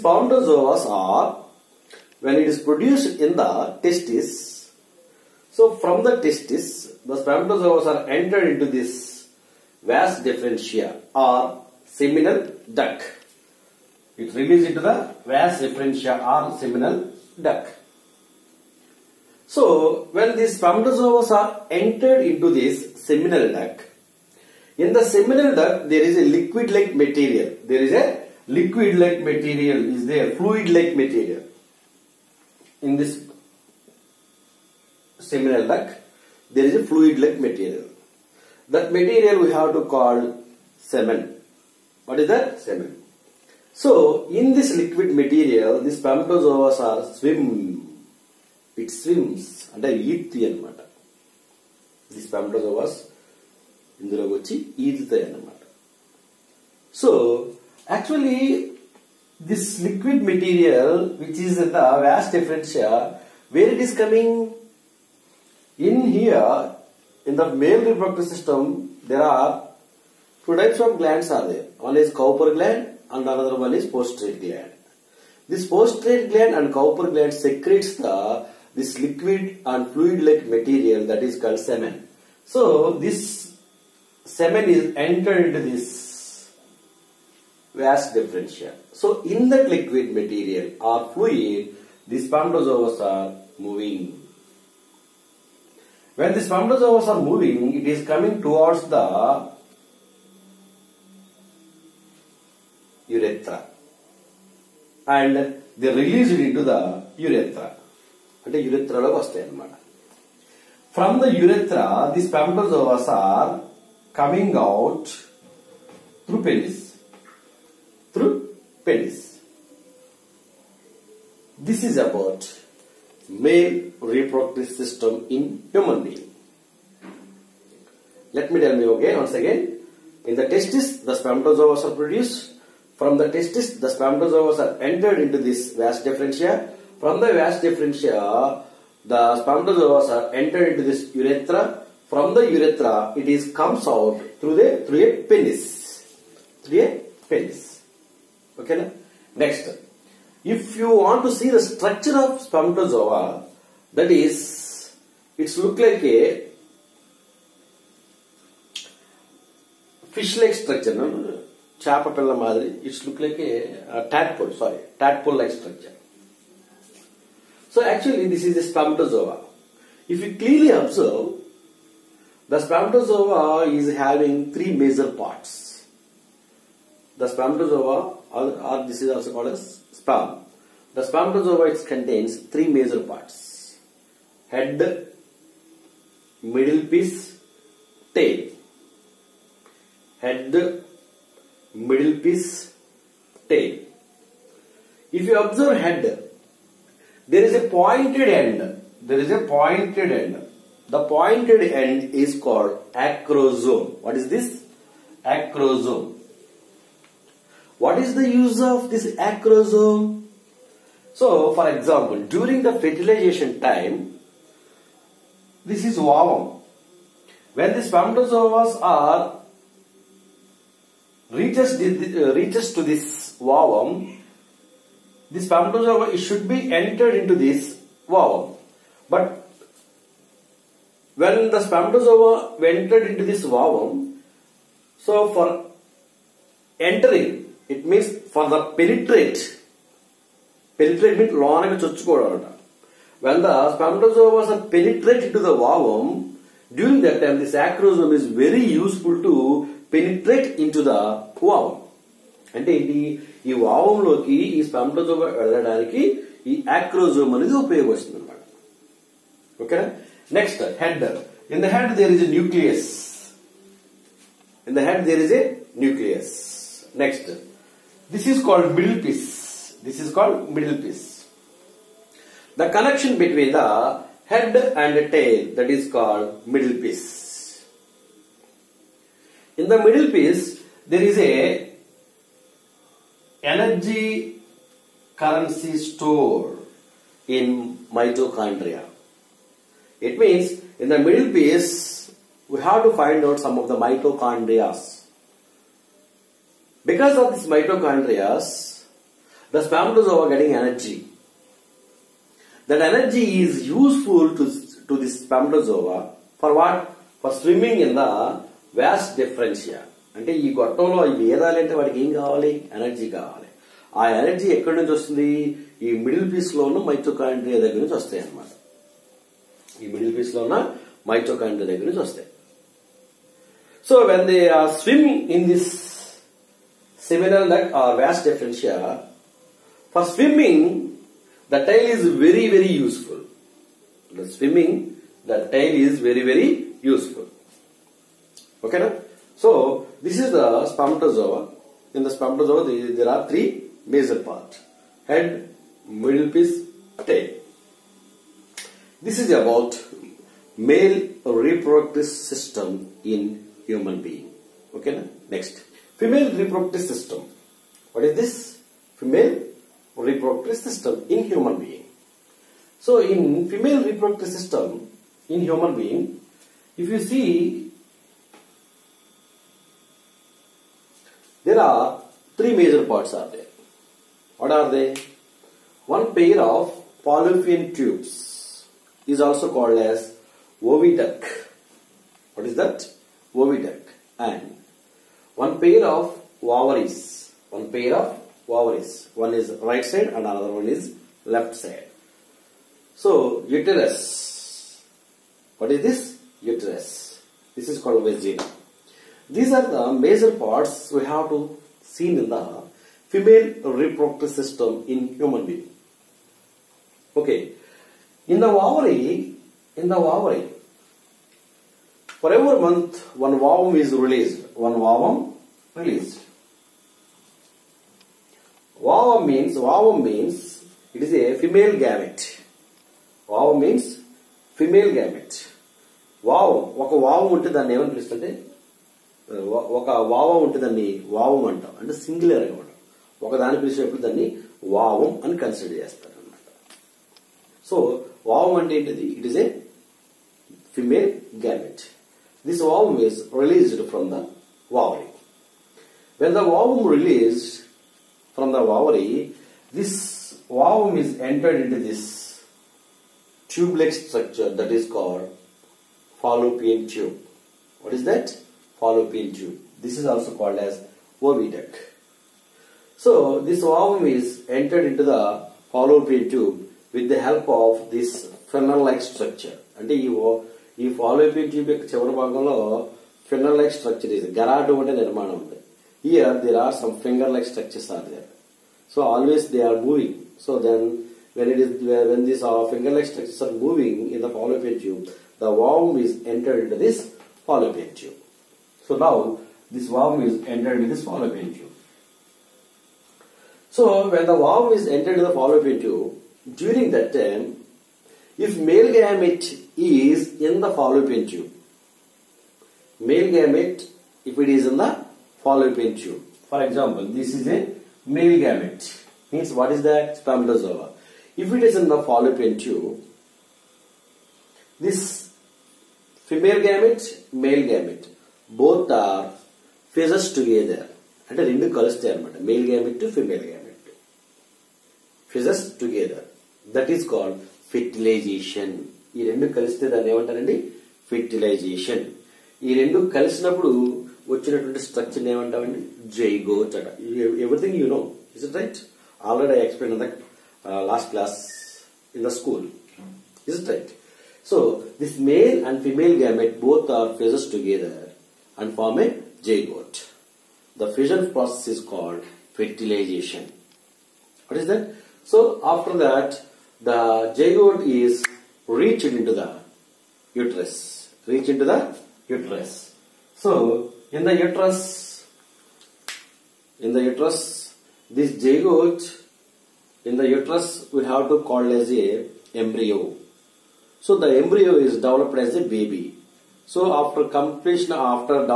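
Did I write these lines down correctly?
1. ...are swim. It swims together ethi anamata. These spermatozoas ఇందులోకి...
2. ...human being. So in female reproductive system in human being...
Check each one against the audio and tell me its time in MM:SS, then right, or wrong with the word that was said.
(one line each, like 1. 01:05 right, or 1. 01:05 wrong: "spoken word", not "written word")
1. 00:46 wrong: "under", not "together"
2. 06:01 right.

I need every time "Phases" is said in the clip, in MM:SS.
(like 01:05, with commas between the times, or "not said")
08:45.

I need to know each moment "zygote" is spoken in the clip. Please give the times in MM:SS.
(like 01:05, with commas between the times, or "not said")
09:17, 09:28.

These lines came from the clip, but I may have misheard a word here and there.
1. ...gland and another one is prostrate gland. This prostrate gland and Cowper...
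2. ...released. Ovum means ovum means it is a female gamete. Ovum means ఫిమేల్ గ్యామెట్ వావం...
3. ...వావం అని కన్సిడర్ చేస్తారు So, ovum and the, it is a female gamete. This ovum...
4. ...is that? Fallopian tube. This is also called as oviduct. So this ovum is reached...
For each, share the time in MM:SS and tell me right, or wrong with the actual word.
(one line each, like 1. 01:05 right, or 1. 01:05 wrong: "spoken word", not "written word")
1. 01:12 right
2. 06:55 right
3. 07:14 right
4. 07:37 wrong: "entered", not "reached".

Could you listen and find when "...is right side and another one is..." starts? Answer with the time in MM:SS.
06:29.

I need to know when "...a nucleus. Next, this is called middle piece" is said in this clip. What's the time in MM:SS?
04:25.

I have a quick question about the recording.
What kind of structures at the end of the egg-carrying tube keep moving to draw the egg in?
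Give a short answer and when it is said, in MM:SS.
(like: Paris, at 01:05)
Finger like structures, at 07:57.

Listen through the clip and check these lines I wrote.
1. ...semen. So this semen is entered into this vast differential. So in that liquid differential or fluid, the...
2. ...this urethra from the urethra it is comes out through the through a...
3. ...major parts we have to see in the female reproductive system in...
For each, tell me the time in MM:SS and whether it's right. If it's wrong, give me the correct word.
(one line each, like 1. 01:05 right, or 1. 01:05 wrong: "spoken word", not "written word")
1. 01:21 wrong: "material", not "differential"
2. 02:20 right
3. 06:39 right.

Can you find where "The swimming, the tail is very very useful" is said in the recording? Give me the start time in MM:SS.
05:34.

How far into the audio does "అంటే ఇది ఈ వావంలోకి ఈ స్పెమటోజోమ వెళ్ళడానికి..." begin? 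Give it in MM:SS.
04:12.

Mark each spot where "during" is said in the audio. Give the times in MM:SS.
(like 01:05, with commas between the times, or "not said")
03:32, 04:06, 08:16.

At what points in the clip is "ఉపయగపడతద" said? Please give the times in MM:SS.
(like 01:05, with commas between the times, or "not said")
04:17.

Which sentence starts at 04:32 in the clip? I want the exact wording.
The connection between the head and the tail that is called middle piece.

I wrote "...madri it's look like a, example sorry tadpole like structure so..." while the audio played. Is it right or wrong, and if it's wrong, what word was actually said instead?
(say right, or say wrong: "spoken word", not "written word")
wrong: "tadpole", not "example".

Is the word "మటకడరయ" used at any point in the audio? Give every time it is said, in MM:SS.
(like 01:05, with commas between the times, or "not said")
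05:16, 05:21.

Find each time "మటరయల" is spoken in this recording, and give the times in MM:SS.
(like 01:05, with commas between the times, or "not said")
01:00.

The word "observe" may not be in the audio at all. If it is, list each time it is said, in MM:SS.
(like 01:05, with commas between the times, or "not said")
02:50, 03:15.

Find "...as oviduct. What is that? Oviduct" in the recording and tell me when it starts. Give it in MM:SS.
06:19.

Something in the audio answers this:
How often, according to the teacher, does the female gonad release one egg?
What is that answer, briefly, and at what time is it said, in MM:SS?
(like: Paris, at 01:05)
Every month, at 06:52.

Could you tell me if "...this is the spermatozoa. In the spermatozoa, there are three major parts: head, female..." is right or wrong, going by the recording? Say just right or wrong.
wrong.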